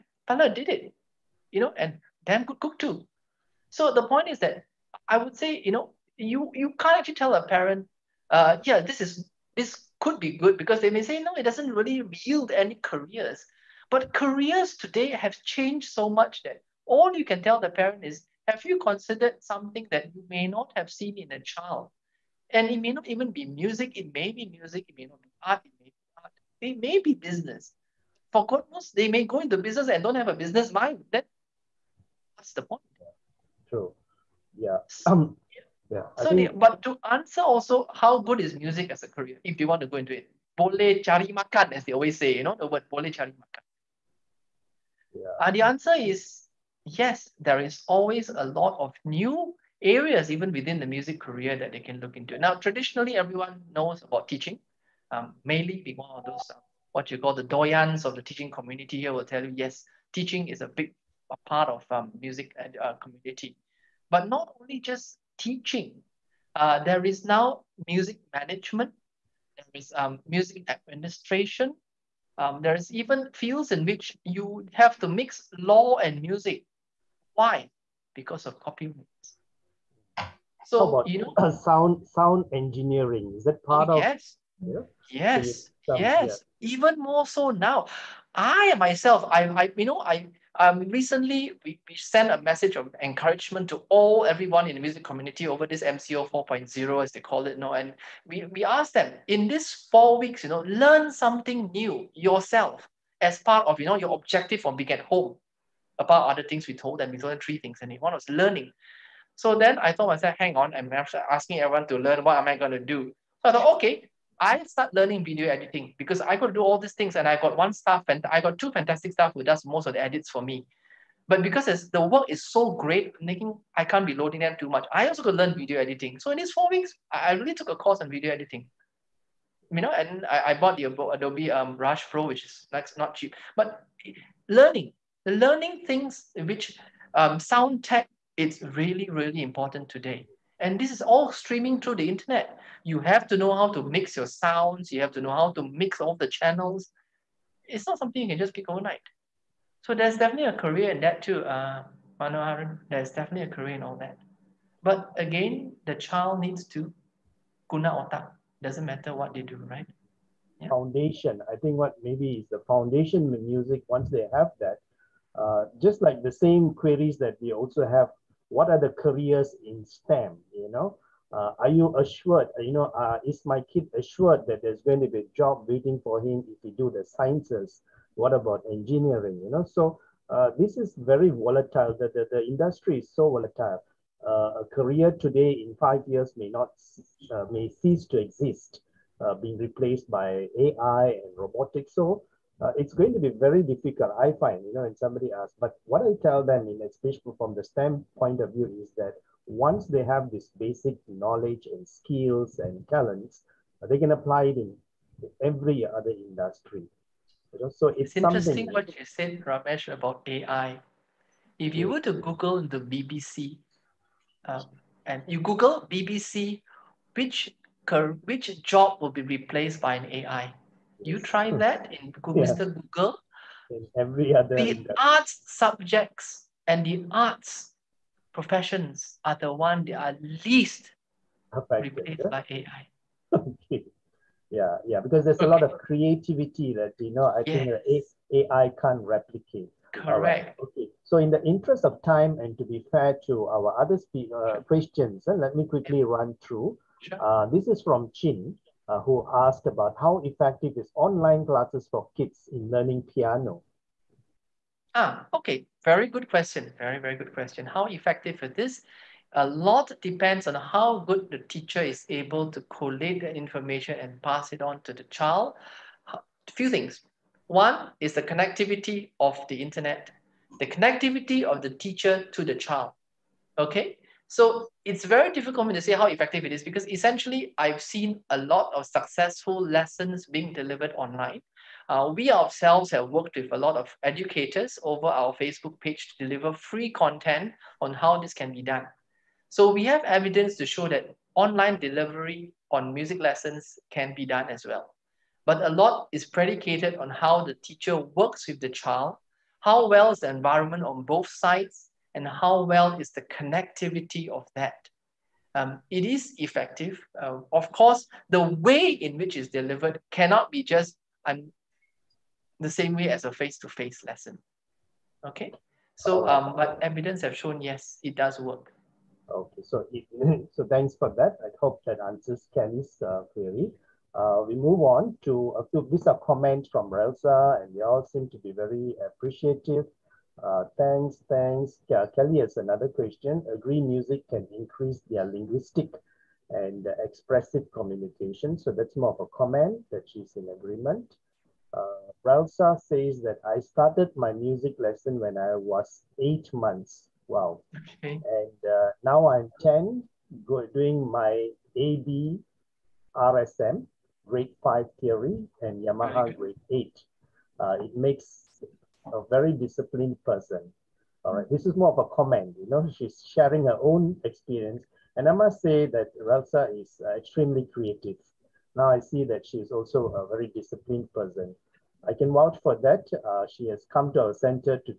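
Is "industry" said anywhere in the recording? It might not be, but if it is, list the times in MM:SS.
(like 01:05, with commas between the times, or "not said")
03:02, 03:26, 03:44.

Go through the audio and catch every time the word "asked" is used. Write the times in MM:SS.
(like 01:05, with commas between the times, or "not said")
01:38, 04:09.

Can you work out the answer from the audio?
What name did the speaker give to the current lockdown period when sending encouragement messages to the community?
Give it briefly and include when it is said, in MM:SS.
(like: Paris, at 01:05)
MCO 4.0, at 01:35.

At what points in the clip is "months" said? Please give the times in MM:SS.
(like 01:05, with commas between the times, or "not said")
05:46.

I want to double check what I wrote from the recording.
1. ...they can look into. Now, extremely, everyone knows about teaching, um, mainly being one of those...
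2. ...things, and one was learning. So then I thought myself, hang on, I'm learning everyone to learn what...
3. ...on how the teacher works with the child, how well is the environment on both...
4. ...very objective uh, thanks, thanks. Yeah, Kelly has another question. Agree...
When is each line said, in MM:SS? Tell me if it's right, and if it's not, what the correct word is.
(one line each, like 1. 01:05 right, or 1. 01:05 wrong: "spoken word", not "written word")
1. 00:51 wrong: "traditionally", not "extremely"
2. 01:47 wrong: "asking", not "learning"
3. 04:56 right
4. 05:28 wrong: "appreciative", not "objective".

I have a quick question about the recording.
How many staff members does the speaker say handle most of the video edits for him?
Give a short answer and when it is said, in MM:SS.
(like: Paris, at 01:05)
2, at 01:58.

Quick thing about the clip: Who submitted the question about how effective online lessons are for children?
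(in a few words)
Chin.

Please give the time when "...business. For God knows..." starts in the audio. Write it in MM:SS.
00:27.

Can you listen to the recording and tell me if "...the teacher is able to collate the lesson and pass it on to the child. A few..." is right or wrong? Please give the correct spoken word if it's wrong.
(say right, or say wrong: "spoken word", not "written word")
wrong: "information", not "lesson".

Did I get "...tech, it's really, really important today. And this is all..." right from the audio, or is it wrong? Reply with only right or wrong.
right.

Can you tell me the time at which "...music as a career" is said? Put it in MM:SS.
00:38.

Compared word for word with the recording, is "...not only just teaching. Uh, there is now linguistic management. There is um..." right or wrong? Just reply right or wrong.
wrong.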